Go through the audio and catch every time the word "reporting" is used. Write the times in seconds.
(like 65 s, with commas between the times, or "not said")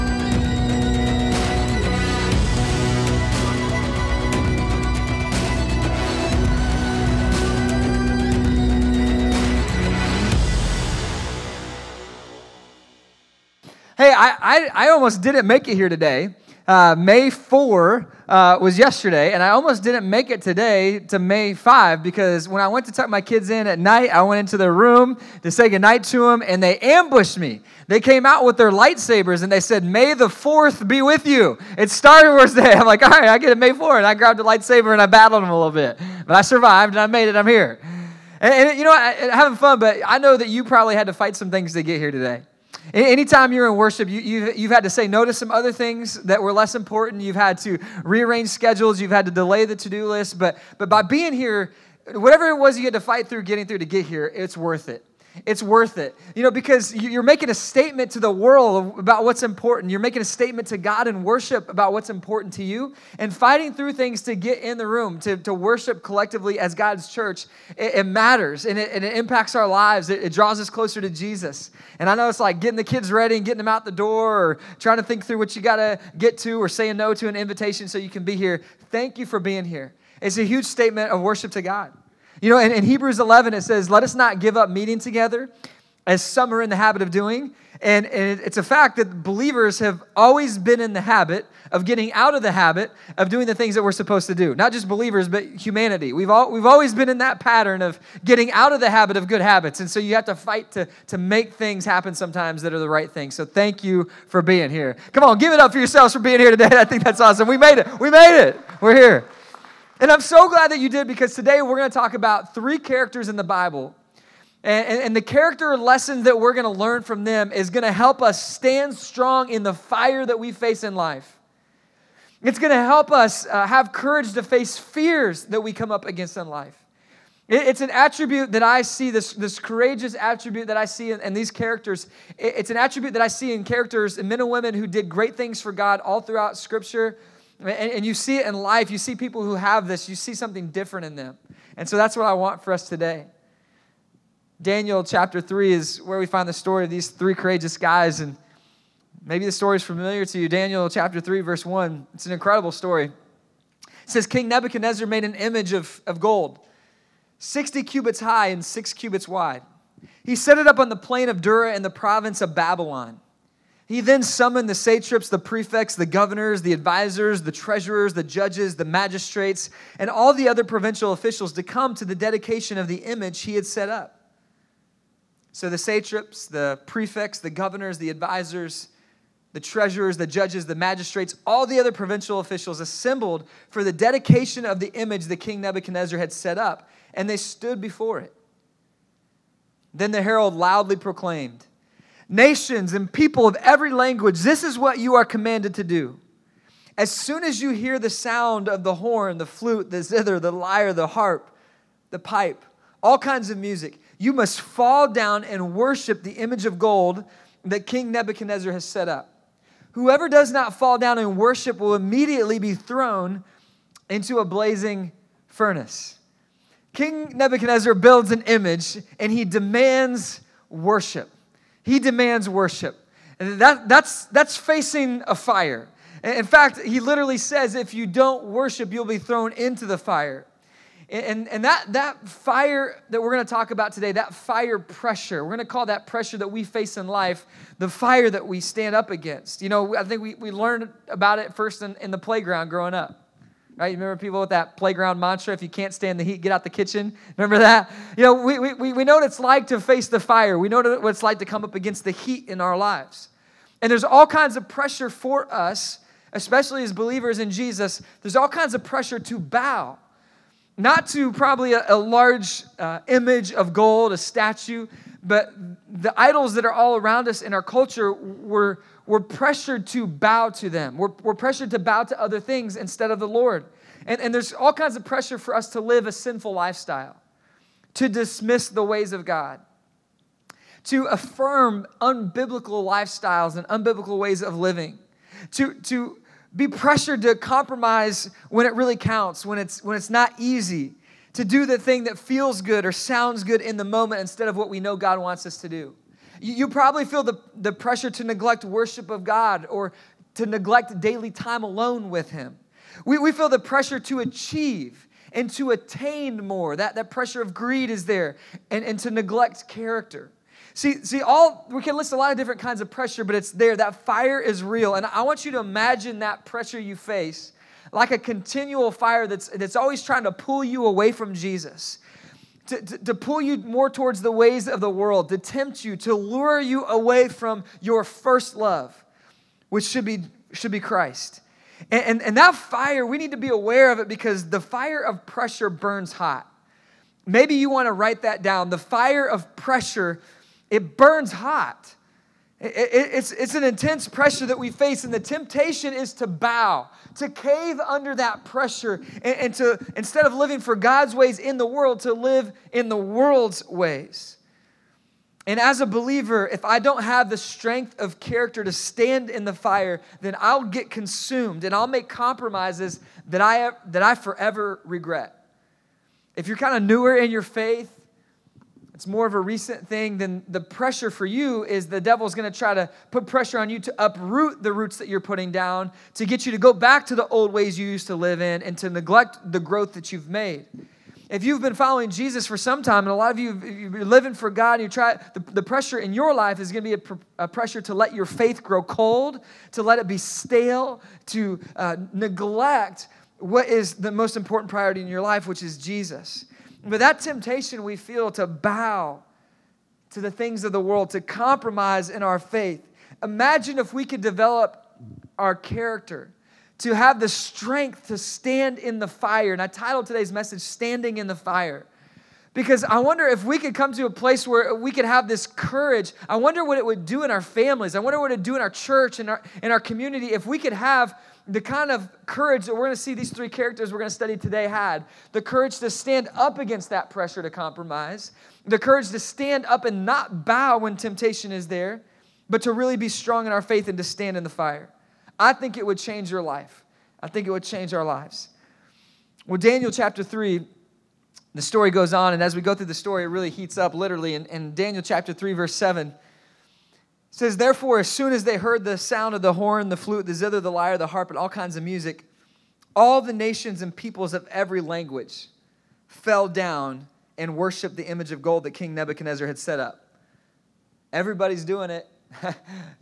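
not said.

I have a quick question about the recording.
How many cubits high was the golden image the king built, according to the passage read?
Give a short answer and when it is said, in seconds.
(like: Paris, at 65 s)
60, at 157 s.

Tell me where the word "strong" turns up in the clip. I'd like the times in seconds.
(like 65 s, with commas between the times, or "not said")
118 s, 433 s.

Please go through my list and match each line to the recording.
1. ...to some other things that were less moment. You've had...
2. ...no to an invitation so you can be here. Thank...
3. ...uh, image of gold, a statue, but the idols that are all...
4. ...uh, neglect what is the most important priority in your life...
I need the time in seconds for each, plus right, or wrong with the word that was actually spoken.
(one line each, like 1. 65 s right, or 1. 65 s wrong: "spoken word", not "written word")
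1. 45 s wrong: "important", not "moment"
2. 76 s right
3. 262 s right
4. 391 s right.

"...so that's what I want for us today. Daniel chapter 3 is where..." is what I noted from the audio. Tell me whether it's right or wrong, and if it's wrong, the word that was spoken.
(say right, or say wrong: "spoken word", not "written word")
right.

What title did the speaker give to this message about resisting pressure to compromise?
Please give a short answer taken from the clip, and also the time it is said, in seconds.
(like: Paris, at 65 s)
Standing in the Fire, at 410 s.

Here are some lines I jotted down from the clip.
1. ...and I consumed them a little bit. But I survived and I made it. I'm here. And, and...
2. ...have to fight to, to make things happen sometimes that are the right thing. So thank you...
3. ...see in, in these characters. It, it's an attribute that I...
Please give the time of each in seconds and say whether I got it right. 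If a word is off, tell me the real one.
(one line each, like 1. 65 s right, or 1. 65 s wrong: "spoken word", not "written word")
1. 34 s wrong: "battled", not "consumed"
2. 100 s right
3. 130 s right.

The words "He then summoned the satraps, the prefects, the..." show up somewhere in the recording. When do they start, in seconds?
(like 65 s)
163 s.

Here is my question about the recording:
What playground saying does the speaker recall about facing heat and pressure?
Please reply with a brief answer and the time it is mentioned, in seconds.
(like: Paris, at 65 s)
If you can't stand the heat, get out the kitchen, at 245 s.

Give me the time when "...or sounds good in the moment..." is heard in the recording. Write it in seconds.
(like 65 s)
292 s.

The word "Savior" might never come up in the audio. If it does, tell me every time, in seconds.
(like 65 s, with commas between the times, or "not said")
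not said.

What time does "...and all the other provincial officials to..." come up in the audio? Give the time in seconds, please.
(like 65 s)
169 s.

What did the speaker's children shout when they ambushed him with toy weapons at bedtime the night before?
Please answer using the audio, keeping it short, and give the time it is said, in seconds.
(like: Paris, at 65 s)
May the 4th be with you, at 29 s.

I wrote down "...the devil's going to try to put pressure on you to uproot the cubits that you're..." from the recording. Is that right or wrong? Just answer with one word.
wrong.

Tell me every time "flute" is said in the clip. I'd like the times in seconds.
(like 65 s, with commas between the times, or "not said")
199 s, 449 s.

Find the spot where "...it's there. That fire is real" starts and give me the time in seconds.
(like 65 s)
313 s.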